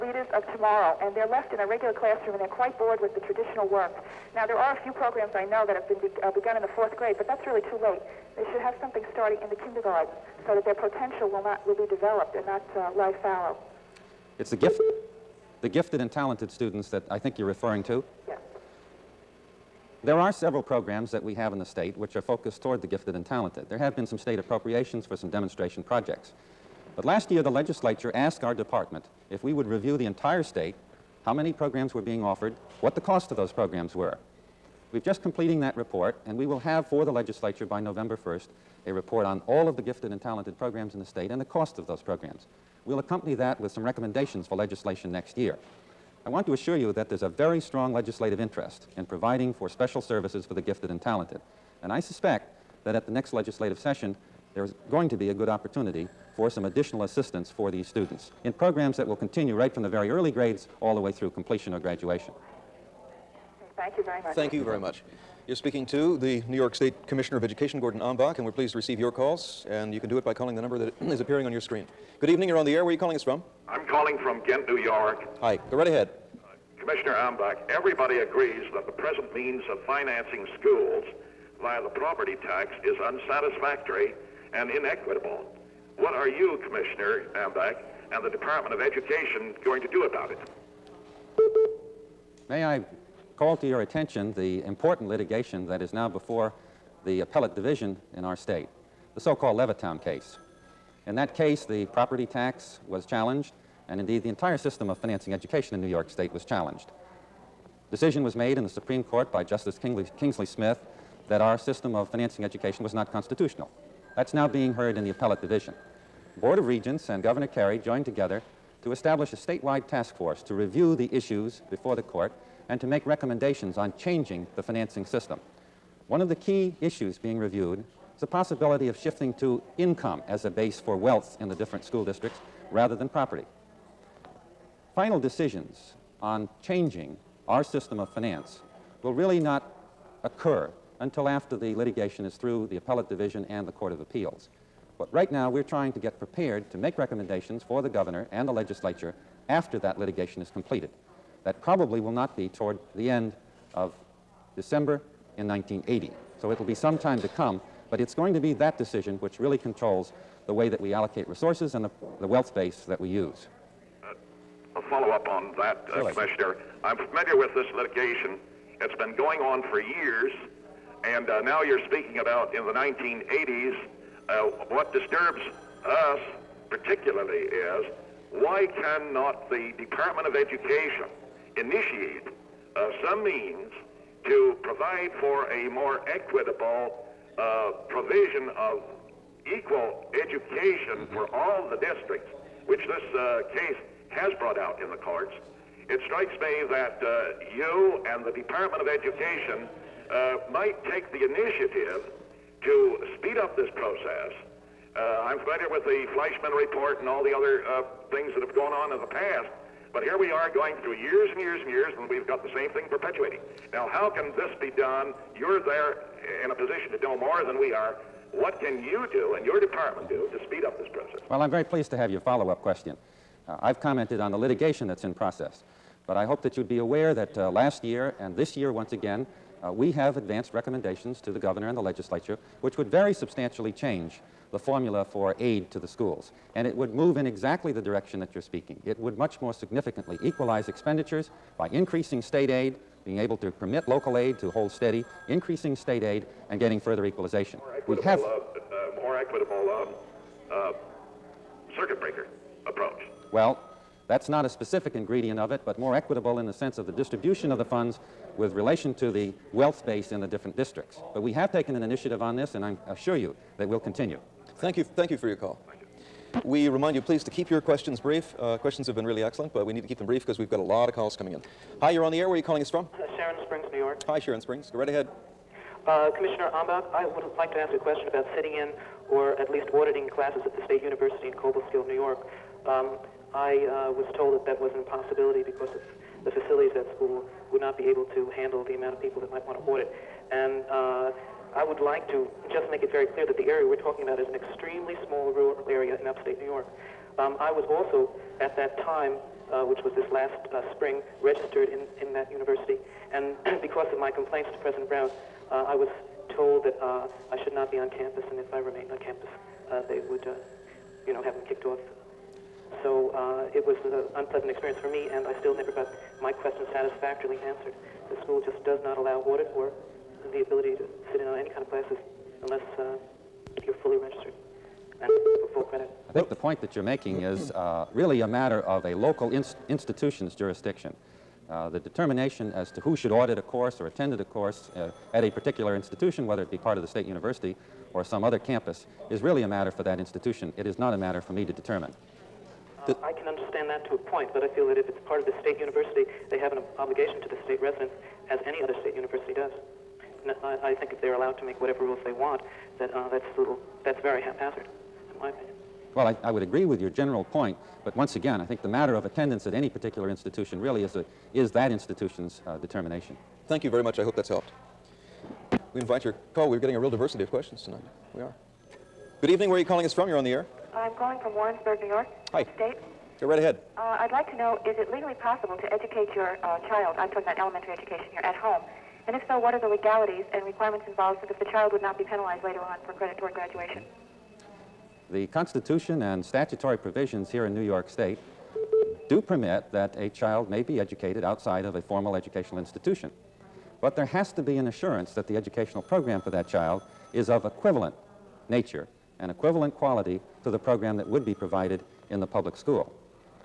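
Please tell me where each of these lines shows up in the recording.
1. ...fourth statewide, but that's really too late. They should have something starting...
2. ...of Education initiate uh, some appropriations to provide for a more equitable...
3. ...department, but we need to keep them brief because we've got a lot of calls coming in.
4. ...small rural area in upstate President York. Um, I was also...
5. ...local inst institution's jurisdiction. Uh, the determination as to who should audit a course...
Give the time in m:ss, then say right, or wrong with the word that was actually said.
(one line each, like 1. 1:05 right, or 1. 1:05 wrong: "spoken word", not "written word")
1. 0:06 wrong: "grade", not "statewide"
2. 3:00 wrong: "means", not "appropriations"
3. 4:29 wrong: "excellent", not "department"
4. 4:55 wrong: "New", not "President"
5. 5:28 right.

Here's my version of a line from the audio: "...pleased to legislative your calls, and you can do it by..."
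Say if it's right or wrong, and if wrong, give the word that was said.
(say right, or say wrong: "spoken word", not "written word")
wrong: "receive", not "legislative".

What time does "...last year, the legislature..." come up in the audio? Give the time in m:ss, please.
0:27.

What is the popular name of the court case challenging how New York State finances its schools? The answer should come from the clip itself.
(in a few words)
Levittown case.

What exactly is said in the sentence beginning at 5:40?
It is not a matter for me to determine.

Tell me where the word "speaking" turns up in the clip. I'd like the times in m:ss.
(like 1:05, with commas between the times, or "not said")
1:05, 2:51, 3:58.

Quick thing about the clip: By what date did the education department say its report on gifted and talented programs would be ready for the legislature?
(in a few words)
November 1st.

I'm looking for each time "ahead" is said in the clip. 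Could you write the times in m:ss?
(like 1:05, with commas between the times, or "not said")
1:15, 4:34, 6:13.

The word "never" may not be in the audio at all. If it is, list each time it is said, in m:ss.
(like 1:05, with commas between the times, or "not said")
5:15.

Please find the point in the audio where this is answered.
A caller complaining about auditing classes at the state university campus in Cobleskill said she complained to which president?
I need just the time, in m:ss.
5:04.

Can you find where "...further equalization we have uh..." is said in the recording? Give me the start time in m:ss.
4:06.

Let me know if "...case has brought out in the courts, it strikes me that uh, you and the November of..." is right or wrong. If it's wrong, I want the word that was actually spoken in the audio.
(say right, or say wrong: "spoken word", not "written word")
wrong: "Department", not "November".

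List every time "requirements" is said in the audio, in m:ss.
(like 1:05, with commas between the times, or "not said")
6:20.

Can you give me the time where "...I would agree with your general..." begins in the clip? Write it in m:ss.
5:56.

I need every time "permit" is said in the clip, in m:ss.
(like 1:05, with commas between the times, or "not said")
4:03, 6:29.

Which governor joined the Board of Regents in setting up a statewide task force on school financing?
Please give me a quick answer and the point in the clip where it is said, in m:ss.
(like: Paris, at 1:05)
Governor Carey, at 1:57.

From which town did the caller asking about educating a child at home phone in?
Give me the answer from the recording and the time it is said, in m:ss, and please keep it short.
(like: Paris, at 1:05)
Warrensburg, New York, at 6:11.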